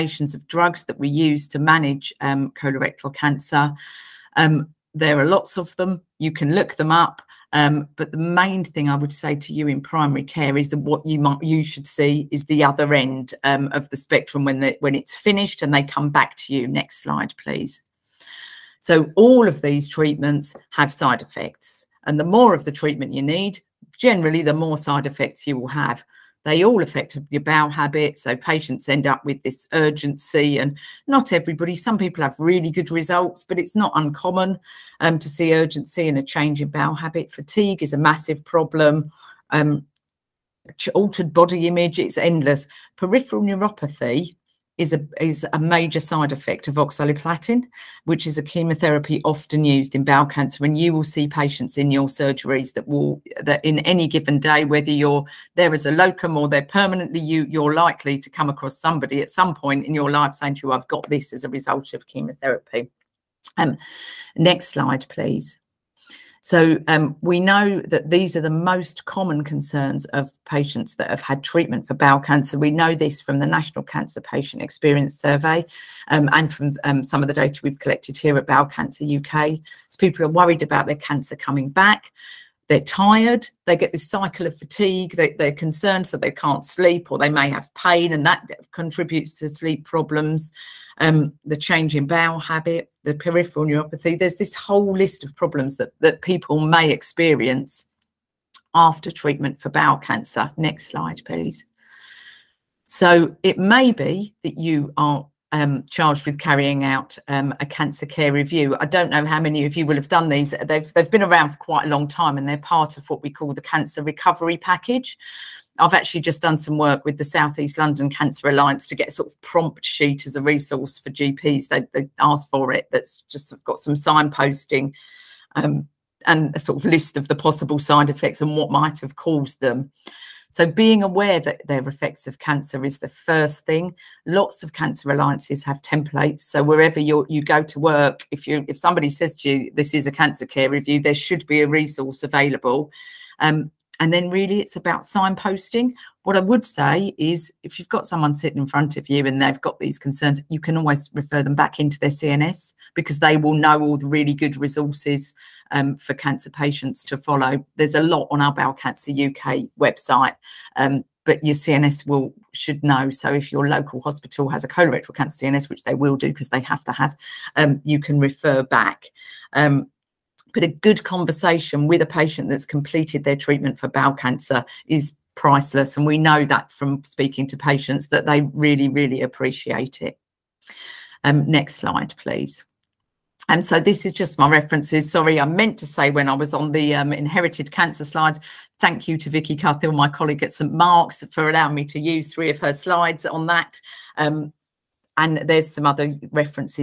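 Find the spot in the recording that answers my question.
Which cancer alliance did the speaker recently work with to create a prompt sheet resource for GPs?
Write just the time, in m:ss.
1:57.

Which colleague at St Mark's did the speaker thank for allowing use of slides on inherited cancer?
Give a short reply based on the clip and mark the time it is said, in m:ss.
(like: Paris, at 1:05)
Vicky Cuthill, at 3:09.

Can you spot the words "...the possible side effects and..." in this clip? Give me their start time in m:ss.
2:07.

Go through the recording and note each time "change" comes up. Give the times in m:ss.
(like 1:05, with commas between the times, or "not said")
0:36, 1:31.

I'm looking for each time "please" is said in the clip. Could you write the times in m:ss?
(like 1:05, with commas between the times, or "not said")
0:17, 1:05, 1:41, 3:02.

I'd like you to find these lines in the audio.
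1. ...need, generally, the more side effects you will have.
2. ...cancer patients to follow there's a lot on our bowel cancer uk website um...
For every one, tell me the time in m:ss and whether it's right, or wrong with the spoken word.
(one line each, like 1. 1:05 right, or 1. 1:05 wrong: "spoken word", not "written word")
1. 0:23 right
2. 2:36 right.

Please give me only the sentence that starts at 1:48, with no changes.
I don't know how many of you will have done these.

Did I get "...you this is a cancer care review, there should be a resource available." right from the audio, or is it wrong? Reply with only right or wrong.
right.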